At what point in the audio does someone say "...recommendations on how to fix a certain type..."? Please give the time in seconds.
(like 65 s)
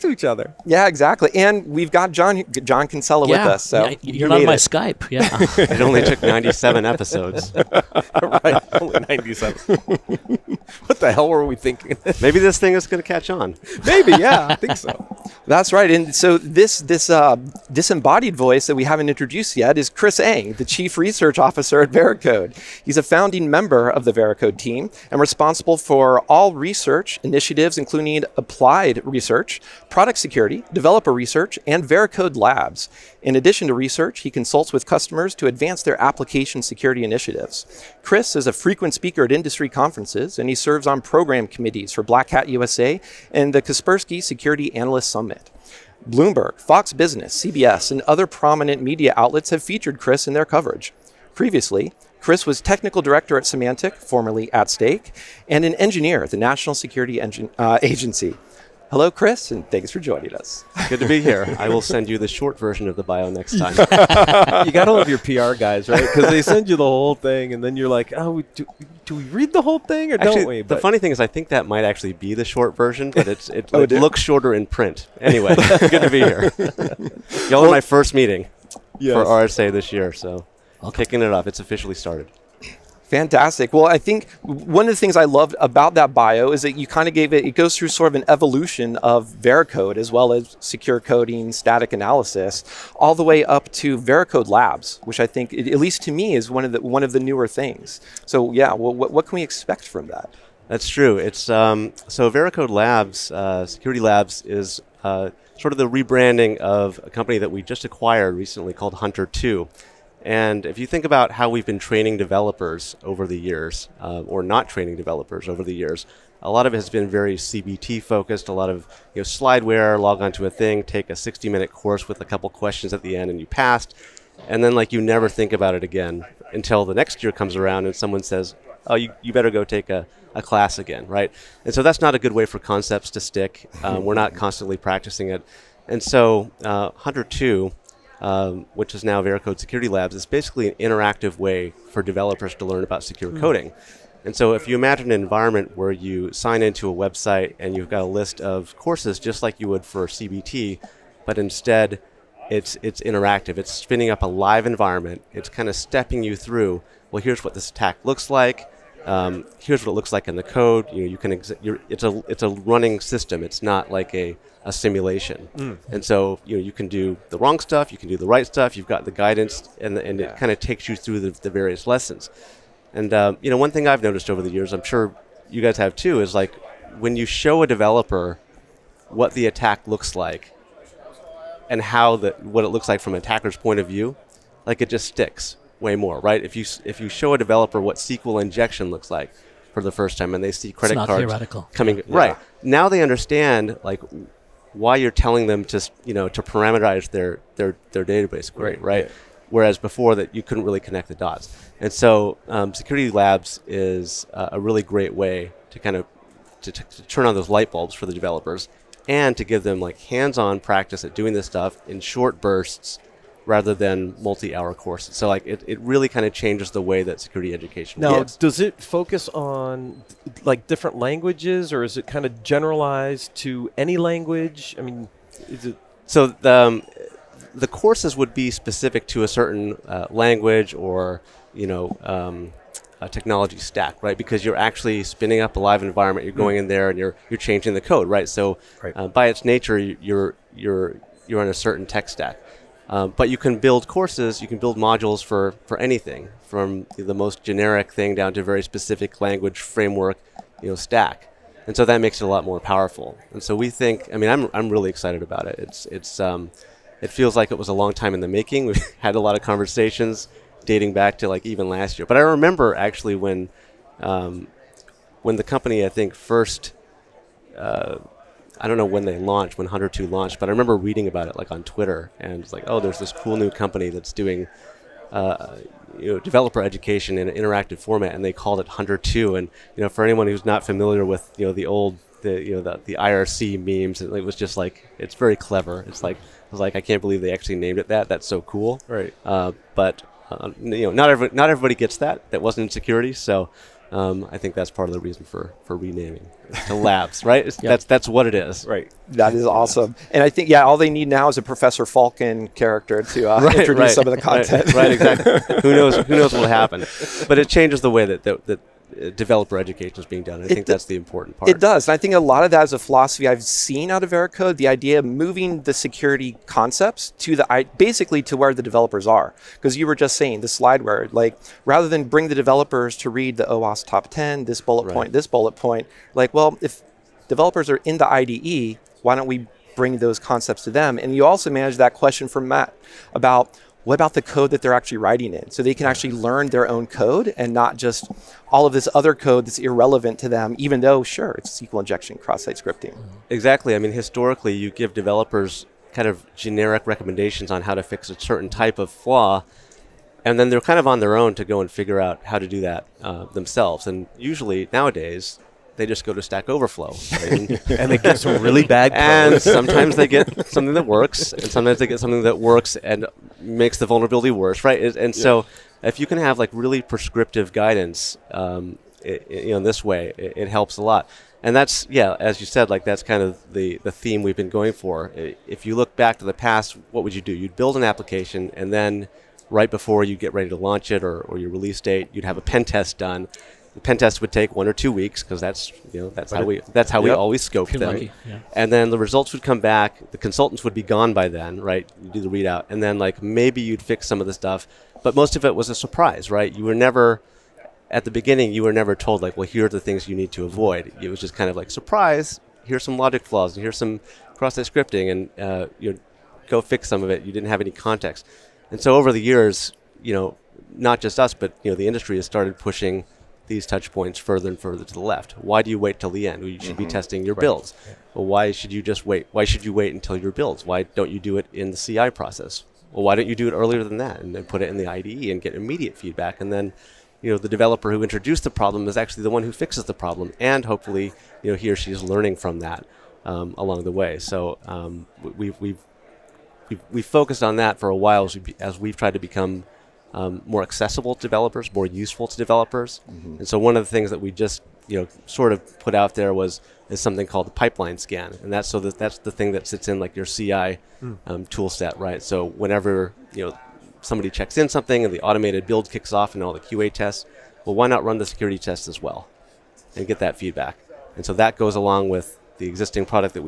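346 s.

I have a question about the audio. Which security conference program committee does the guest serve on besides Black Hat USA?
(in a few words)
Kaspersky Security Analyst Summit.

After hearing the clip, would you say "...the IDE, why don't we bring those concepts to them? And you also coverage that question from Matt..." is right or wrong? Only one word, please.
wrong.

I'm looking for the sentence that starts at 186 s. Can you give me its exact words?
If you if you show a developer what SQL injection looks like for the first time, and they see credit cards theoretical.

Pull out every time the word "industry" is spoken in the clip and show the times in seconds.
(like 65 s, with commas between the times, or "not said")
39 s, 411 s.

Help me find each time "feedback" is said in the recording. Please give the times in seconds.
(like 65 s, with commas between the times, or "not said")
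425 s, 460 s.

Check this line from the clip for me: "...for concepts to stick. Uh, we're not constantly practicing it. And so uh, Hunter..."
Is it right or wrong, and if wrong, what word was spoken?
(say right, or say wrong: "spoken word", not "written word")
right.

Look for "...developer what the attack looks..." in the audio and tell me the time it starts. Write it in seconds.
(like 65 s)
177 s.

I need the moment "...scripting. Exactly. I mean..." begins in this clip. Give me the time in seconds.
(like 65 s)
342 s.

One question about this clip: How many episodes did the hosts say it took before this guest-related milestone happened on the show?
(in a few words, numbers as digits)
97.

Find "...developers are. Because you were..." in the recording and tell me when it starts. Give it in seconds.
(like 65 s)
318 s.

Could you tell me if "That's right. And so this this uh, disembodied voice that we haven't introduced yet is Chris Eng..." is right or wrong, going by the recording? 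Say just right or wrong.
right.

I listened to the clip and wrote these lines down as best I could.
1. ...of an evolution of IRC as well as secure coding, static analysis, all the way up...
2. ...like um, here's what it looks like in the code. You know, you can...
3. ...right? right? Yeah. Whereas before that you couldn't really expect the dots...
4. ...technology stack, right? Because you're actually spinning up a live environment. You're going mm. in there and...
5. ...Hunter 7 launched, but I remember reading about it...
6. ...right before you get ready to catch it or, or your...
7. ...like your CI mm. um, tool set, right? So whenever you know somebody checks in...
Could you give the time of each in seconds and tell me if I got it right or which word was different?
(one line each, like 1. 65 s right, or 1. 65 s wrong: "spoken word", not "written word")
1. 88 s wrong: "Veracode", not "IRC"
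2. 158 s right
3. 198 s wrong: "connect", not "expect"
4. 233 s right
5. 269 s wrong: "2", not "7"
6. 379 s wrong: "launch", not "catch"
7. 450 s right.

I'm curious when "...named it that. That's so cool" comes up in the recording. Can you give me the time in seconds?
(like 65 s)
287 s.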